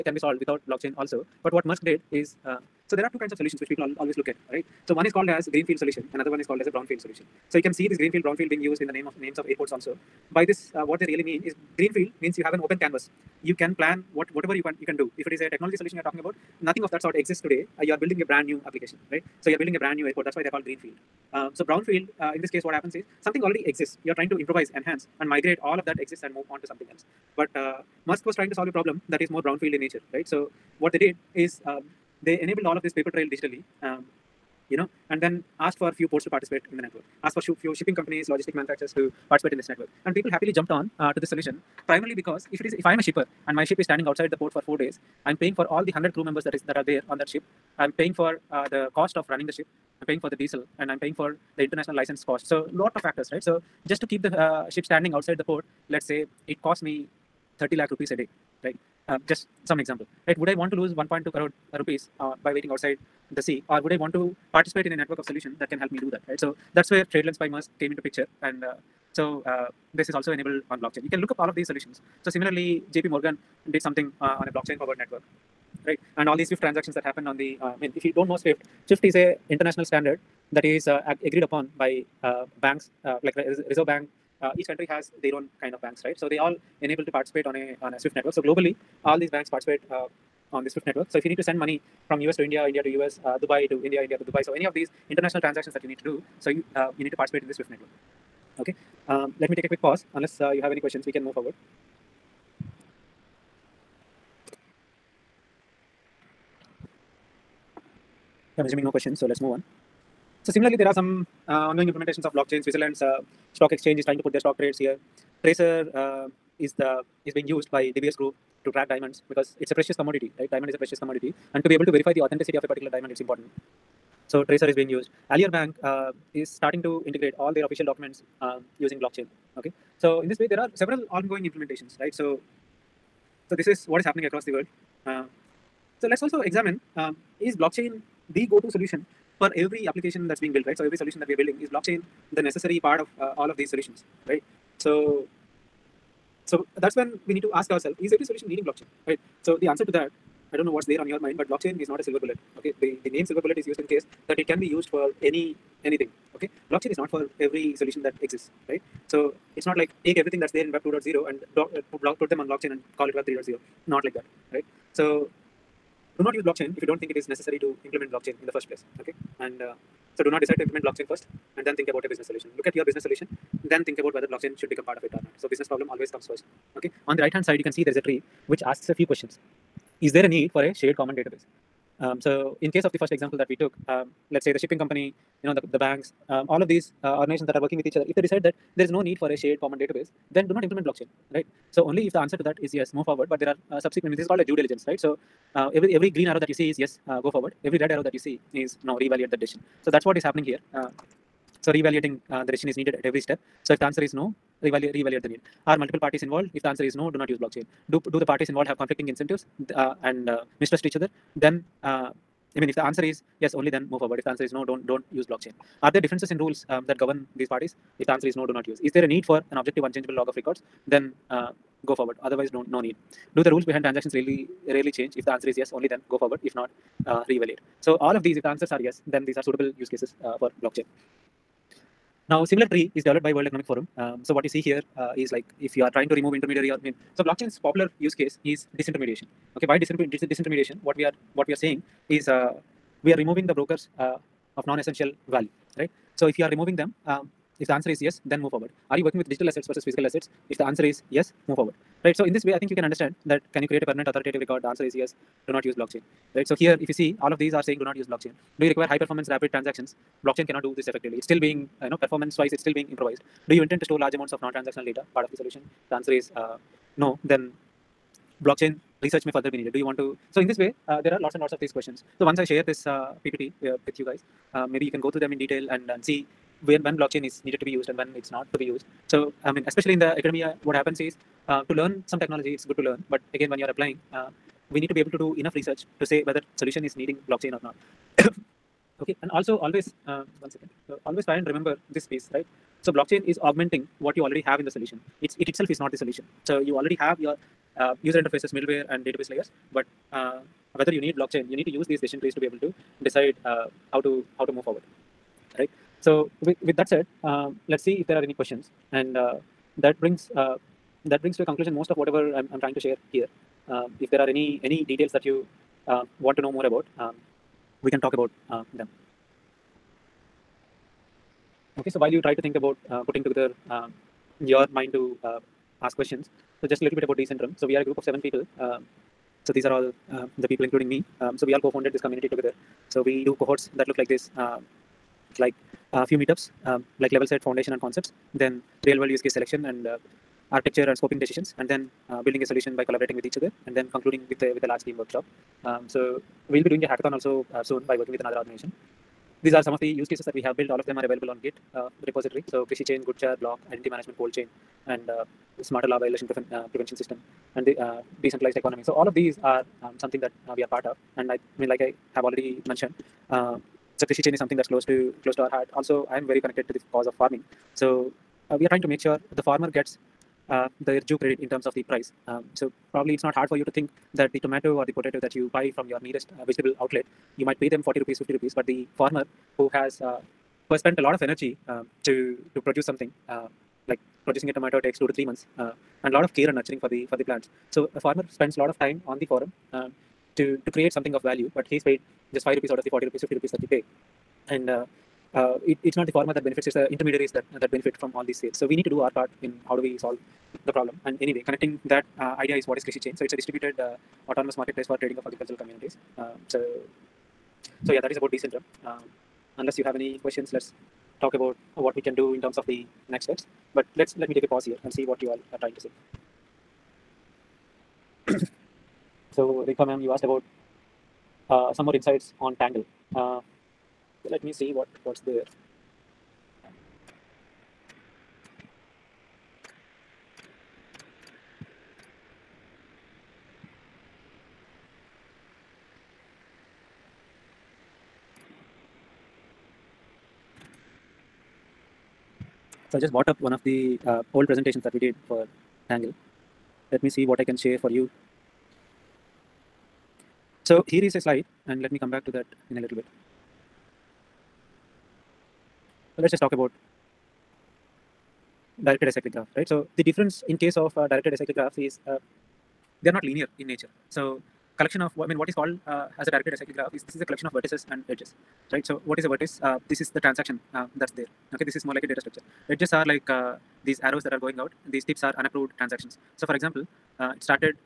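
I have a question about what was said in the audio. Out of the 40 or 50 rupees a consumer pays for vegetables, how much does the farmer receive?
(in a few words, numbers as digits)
5 rupees.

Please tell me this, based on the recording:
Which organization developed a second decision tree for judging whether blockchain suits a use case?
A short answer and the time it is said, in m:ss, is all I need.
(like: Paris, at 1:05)
World Economic Forum, at 3:53.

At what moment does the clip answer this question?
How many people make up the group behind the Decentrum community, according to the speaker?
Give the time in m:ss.
5:28.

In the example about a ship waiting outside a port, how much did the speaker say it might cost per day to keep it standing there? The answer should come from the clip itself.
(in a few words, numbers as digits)
30 lakh rupees.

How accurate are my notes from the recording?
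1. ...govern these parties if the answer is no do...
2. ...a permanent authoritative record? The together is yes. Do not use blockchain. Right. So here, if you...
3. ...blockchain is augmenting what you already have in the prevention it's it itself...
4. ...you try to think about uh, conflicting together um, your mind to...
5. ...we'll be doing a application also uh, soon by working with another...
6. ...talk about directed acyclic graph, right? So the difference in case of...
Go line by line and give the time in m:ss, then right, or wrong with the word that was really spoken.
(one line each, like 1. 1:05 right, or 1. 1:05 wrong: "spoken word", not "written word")
1. 3:36 right
2. 4:13 wrong: "answer", not "together"
3. 4:52 wrong: "solution", not "prevention"
4. 5:22 wrong: "putting", not "conflicting"
5. 5:46 wrong: "hackathon", not "application"
6. 7:36 right.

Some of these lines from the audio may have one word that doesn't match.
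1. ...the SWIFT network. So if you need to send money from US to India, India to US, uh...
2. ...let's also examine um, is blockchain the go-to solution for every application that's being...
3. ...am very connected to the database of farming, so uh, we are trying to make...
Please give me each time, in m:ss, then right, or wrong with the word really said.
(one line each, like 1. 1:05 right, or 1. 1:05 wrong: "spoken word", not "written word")
1. 1:30 right
2. 2:16 right
3. 6:06 wrong: "cause", not "database".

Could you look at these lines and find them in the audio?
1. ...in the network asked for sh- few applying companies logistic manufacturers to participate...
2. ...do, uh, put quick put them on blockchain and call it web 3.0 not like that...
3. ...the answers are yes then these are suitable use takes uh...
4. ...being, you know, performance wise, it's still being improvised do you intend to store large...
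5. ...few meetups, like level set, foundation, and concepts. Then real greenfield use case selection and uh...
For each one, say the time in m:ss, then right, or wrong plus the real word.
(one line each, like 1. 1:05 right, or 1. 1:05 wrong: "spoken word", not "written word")
1. 0:36 wrong: "shipping", not "applying"
2. 2:41 wrong: "block", not "quick"
3. 3:48 wrong: "cases", not "takes"
4. 4:21 right
5. 5:36 wrong: "world", not "greenfield".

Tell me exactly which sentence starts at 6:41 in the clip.
And anyway, connecting that uh, idea is what is Krishi Chain.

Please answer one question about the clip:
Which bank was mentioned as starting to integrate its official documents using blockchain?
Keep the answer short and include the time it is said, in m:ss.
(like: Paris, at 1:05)
Alior Bank, at 2:05.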